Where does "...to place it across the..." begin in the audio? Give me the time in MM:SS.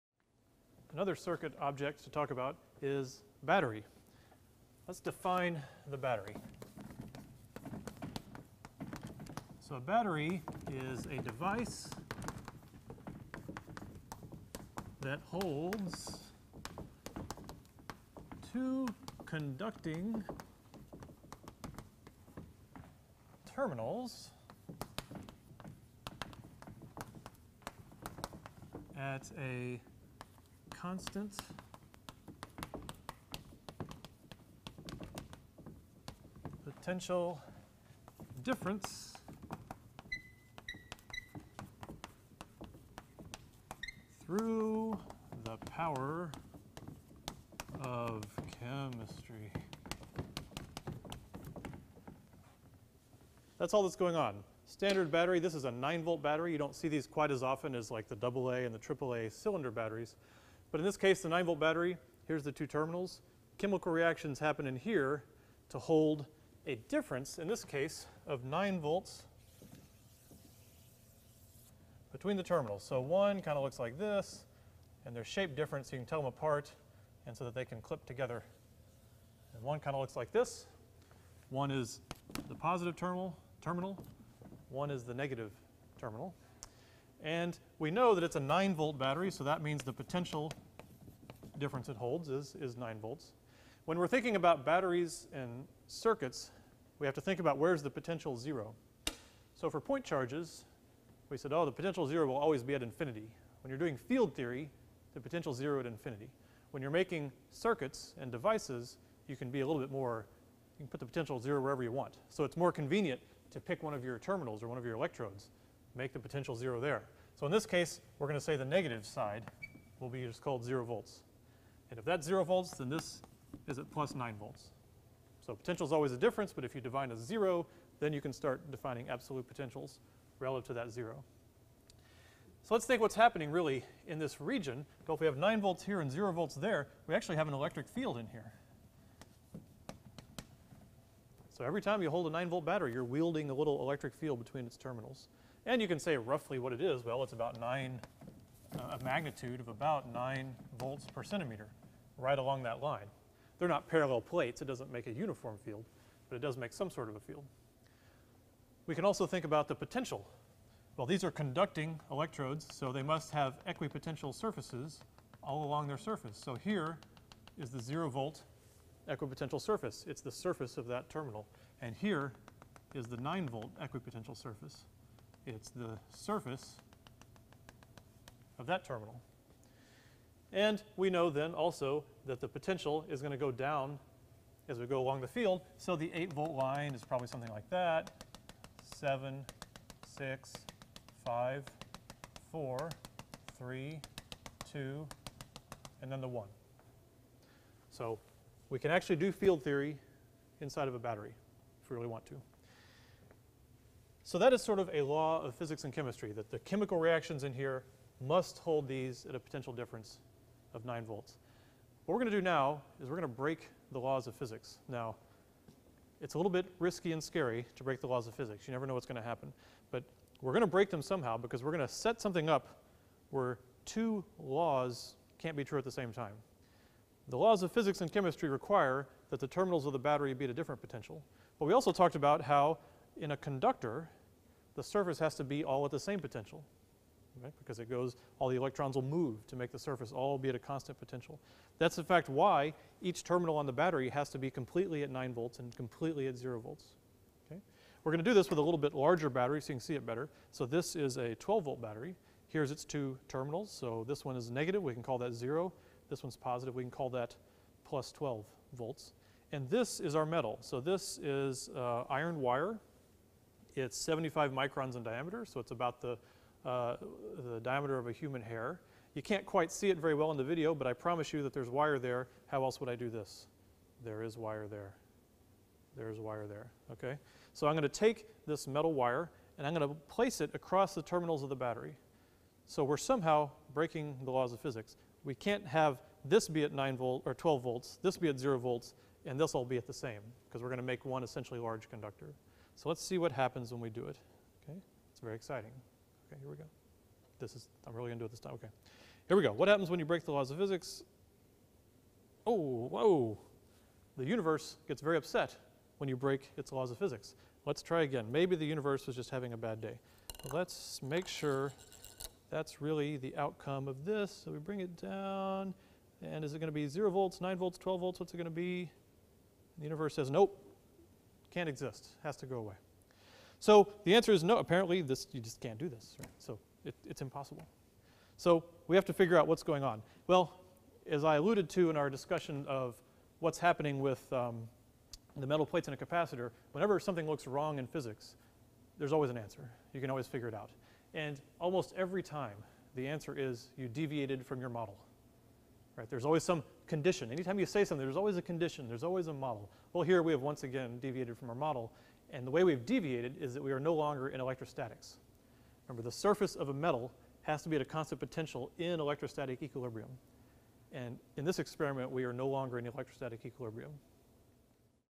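04:39.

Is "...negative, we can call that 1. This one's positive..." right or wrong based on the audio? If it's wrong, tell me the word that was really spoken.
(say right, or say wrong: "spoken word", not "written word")
wrong: "0", not "1".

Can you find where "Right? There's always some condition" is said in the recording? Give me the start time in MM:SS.
05:46.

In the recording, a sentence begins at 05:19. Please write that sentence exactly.
The universe says, nope, can't exist.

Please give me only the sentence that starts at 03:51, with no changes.
But we also talked about how in a conductor, the surface has to be all at the same potential, right?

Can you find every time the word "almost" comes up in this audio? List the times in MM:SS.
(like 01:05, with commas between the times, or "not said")
05:41.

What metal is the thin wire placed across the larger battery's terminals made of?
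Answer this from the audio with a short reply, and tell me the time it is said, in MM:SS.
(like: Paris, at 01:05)
iron, at 04:22.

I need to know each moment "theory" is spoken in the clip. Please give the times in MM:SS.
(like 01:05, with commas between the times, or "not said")
01:44, 03:19.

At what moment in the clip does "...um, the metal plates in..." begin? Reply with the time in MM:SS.
05:34.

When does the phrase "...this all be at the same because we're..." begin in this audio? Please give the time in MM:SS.
04:49.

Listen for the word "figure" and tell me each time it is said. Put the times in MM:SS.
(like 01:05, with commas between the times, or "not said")
05:29, 05:40.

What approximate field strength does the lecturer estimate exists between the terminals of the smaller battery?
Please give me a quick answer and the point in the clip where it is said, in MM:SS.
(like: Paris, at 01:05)
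9 volts per centimeter, at 02:30.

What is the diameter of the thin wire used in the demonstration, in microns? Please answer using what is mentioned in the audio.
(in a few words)
75.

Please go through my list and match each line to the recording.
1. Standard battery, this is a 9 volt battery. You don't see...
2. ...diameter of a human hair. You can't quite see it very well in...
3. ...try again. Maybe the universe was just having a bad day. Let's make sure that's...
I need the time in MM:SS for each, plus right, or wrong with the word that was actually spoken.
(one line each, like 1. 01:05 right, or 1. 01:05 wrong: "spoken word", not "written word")
1. 00:54 right
2. 04:27 right
3. 05:07 right.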